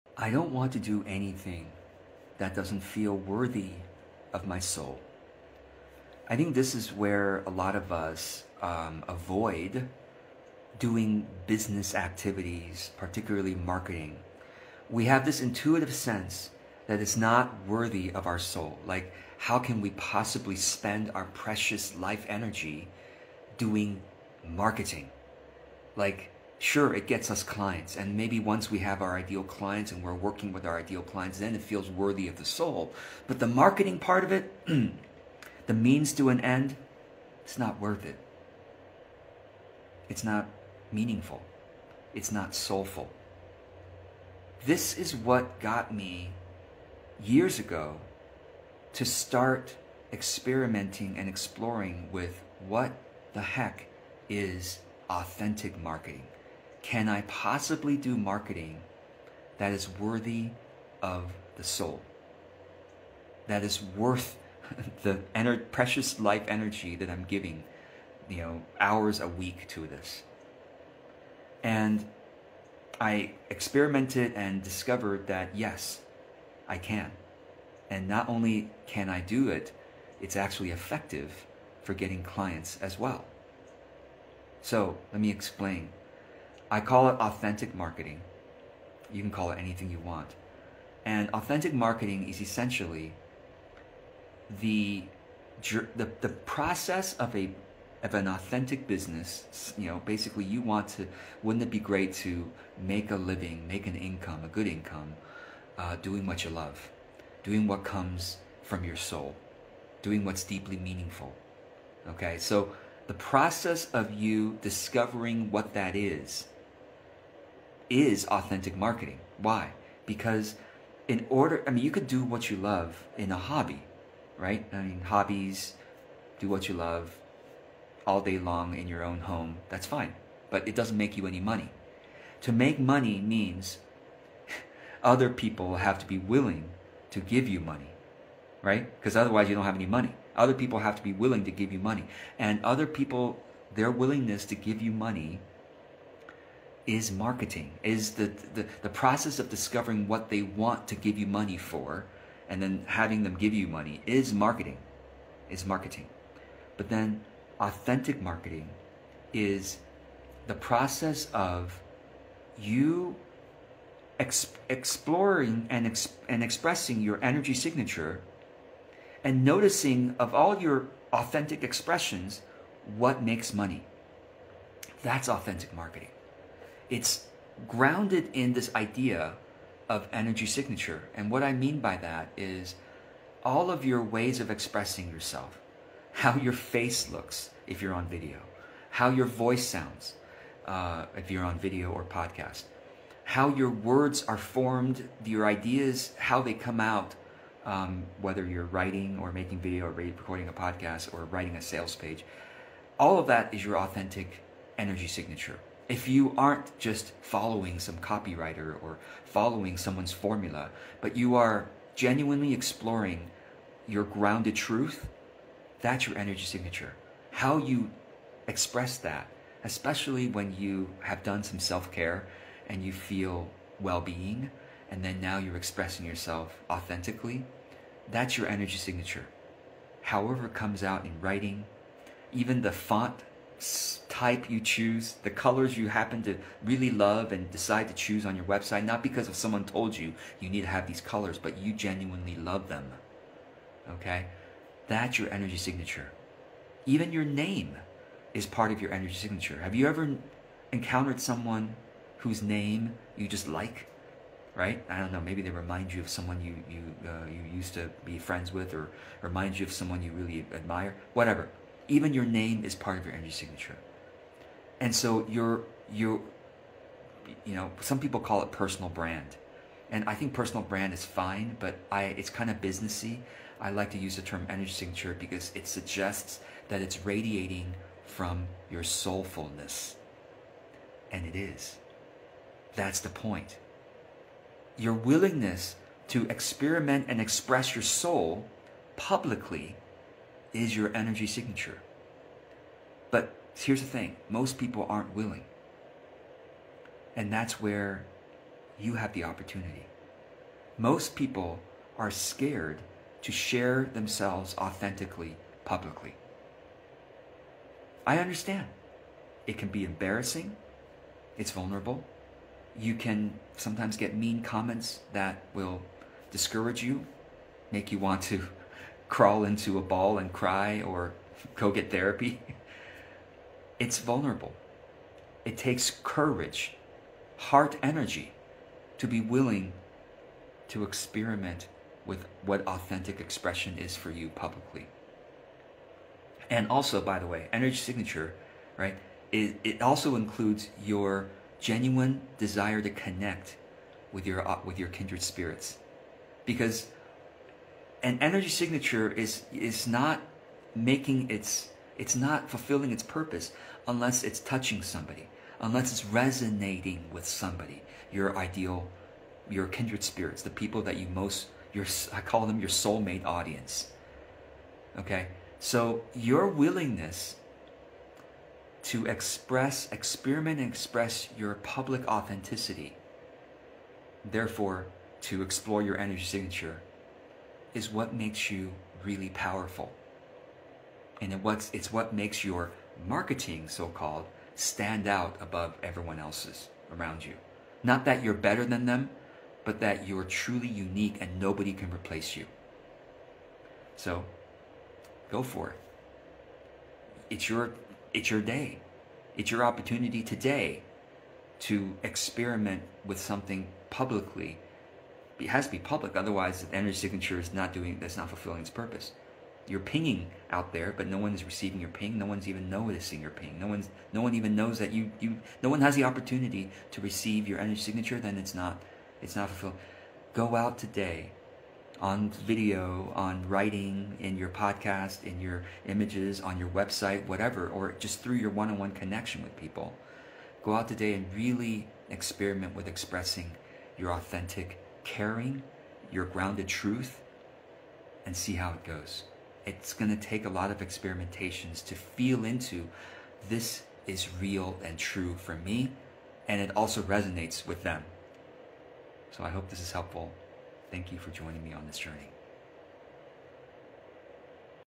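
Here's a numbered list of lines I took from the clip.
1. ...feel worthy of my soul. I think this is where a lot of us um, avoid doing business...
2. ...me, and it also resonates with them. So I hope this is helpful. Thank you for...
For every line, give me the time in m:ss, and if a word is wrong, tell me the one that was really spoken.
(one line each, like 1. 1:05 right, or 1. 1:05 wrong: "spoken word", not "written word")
1. 0:02 right
2. 7:25 right.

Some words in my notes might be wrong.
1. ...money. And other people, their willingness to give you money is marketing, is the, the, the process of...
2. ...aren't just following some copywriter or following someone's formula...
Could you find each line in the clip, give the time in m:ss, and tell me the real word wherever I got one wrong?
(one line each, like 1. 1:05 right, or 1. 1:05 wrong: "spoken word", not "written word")
1. 2:21 right
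2. 3:26 right.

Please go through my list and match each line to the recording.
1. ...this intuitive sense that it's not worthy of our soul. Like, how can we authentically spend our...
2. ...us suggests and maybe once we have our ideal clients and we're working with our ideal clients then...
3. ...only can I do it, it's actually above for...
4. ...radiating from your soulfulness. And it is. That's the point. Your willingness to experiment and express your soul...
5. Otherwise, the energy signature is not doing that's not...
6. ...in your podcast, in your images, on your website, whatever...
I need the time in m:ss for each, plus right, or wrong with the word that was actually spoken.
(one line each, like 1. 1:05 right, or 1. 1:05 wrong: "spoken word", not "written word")
1. 0:15 wrong: "possibly", not "authentically"
2. 0:27 wrong: "clients", not "suggests"
3. 1:18 wrong: "effective", not "above"
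4. 4:37 right
5. 6:46 right
6. 7:04 right.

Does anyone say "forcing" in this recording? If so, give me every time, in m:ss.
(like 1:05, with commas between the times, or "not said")
not said.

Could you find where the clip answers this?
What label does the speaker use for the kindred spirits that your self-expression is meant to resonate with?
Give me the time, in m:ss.
6:02.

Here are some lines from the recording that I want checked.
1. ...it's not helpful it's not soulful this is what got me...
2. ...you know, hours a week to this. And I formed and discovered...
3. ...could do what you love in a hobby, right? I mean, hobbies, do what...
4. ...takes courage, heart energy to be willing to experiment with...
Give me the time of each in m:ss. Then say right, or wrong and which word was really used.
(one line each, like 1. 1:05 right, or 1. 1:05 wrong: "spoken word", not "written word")
1. 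0:40 wrong: "meaningful", not "helpful"
2. 1:08 wrong: "experimented", not "formed"
3. 2:01 right
4. 5:25 right.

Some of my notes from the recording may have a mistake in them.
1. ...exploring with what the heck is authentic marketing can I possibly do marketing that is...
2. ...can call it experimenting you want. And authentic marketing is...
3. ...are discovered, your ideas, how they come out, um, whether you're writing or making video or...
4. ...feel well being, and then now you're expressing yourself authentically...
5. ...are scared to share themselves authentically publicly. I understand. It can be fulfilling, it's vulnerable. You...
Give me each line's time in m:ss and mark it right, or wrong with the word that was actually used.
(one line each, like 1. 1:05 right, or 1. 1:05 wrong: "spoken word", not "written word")
1. 0:51 right
2. 1:29 wrong: "anything", not "experimenting"
3. 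3:14 wrong: "formed", not "discovered"
4. 3:42 right
5. 5:01 wrong: "embarrassing", not "fulfilling".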